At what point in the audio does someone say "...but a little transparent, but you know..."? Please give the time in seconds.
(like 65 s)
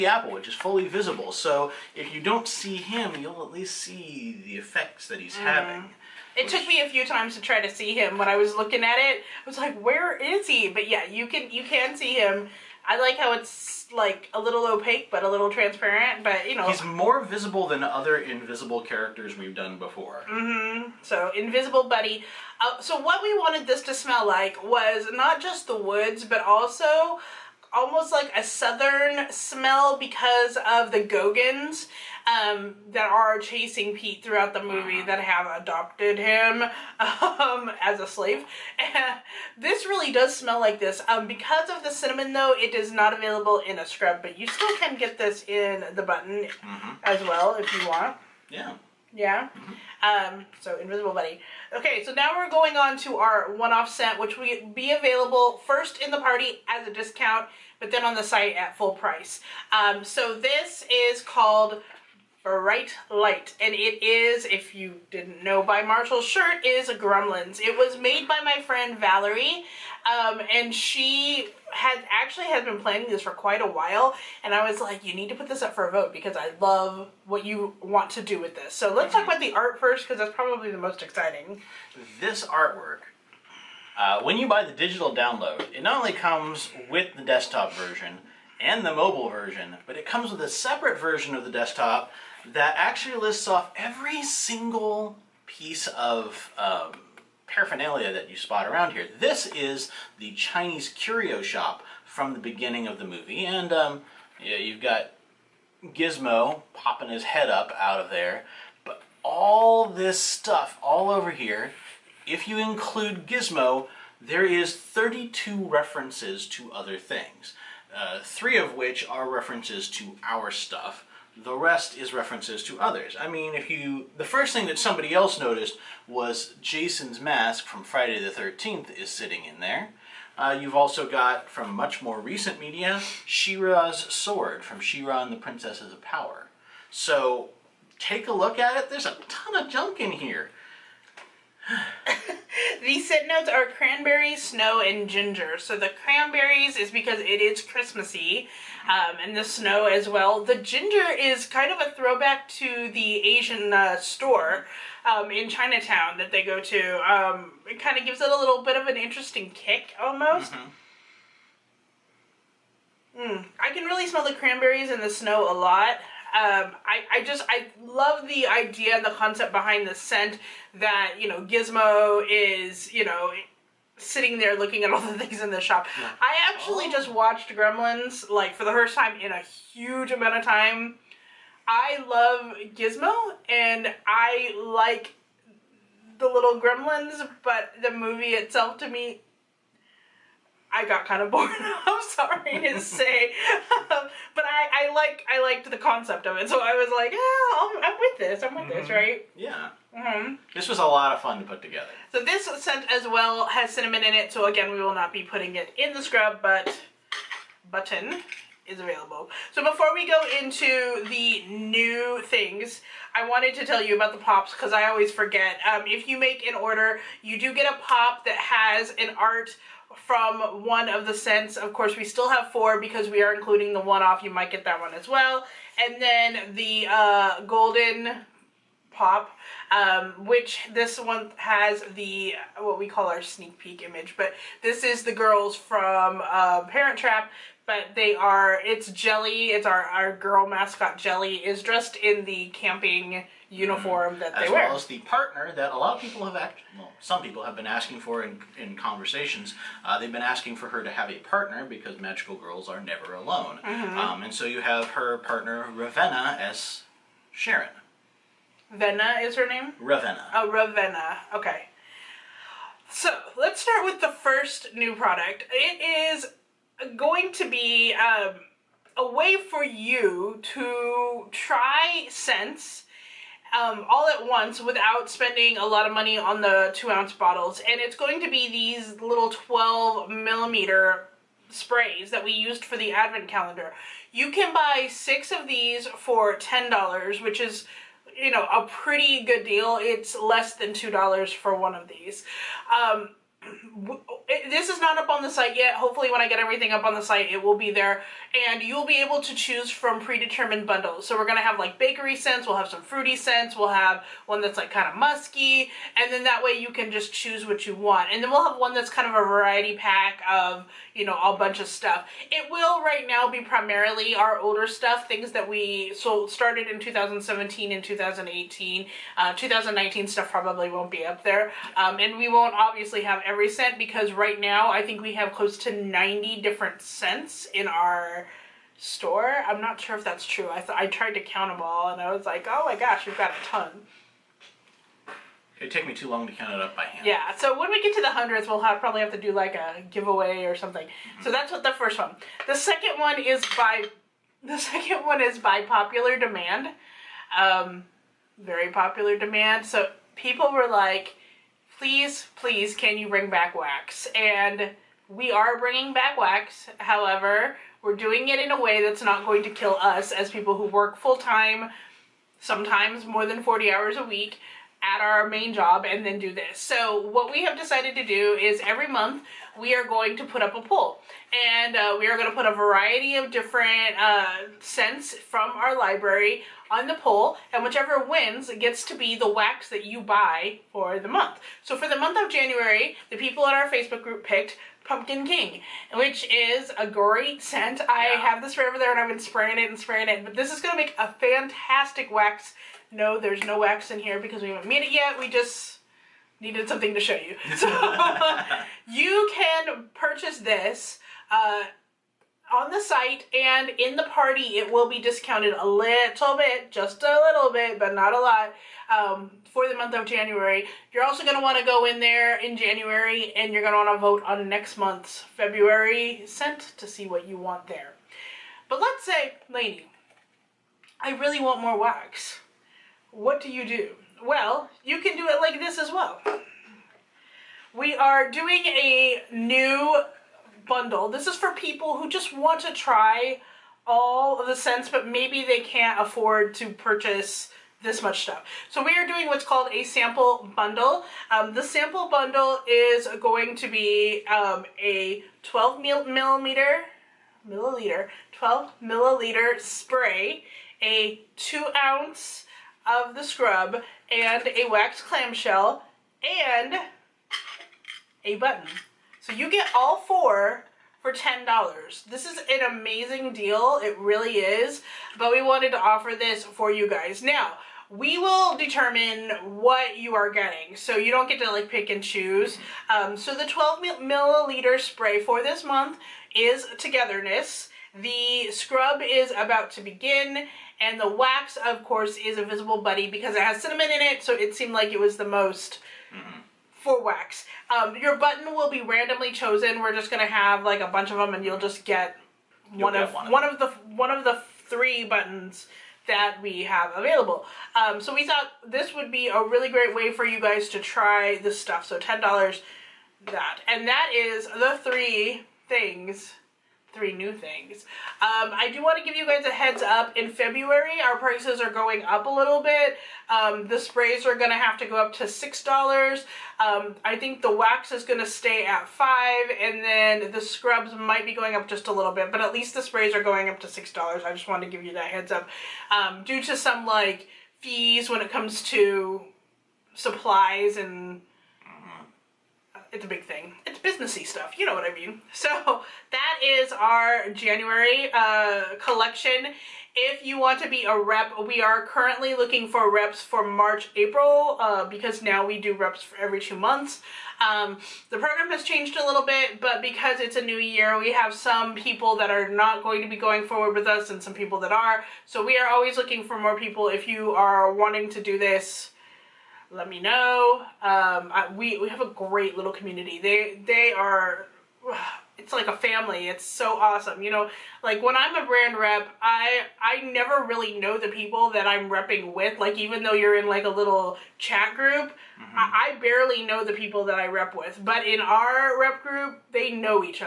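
15 s.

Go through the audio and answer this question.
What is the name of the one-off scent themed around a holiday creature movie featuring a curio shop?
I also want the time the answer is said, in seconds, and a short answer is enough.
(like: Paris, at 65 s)
Bright Light, at 62 s.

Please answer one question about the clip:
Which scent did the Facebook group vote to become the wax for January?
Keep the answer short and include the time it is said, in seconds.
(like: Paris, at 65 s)
Pumpkin King, at 384 s.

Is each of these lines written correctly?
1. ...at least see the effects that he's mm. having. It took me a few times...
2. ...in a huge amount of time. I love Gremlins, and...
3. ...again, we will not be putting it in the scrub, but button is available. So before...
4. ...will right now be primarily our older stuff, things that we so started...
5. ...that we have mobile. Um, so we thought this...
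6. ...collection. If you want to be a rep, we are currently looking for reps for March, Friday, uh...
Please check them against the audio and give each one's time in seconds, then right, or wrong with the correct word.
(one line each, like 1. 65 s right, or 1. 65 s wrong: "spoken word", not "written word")
1. 3 s right
2. 179 s wrong: "Gizmo", not "Gremlins"
3. 204 s right
4. 312 s right
5. 496 s wrong: "available", not "mobile"
6. 538 s wrong: "April", not "Friday".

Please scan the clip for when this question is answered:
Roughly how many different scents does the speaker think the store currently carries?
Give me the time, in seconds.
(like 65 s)
325 s.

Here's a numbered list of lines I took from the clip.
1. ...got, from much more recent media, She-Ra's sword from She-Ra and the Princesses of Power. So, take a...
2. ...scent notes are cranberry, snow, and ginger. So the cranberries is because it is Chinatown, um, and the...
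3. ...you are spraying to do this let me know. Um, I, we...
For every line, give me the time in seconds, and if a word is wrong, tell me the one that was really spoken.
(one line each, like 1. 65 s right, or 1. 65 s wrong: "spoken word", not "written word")
1. 131 s right
2. 143 s wrong: "Christmassy", not "Chinatown"
3. 557 s wrong: "wanting", not "spraying".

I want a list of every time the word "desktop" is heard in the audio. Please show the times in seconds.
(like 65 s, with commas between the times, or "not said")
87 s, 91 s.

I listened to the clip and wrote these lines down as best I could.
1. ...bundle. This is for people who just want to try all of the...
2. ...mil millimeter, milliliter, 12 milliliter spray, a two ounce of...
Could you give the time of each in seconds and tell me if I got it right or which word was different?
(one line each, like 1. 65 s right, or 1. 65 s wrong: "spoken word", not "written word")
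1. 430 s right
2. 445 s right.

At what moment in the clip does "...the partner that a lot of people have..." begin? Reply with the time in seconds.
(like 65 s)
244 s.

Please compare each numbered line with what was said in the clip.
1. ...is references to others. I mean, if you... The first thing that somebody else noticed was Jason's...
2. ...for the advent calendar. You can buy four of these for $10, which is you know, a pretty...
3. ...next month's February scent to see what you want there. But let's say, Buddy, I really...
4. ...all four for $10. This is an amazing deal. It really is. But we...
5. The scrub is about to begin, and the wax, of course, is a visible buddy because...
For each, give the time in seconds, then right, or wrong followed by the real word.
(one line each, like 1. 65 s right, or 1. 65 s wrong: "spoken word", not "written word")
1. 121 s right
2. 282 s wrong: "six", not "four"
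3. 414 s wrong: "Laney", not "Buddy"
4. 459 s right
5. 478 s right.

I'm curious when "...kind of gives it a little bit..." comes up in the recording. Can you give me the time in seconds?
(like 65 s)
157 s.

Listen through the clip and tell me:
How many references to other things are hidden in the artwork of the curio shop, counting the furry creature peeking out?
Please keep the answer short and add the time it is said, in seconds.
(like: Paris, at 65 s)
32, at 114 s.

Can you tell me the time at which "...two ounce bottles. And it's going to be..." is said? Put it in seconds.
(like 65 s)
276 s.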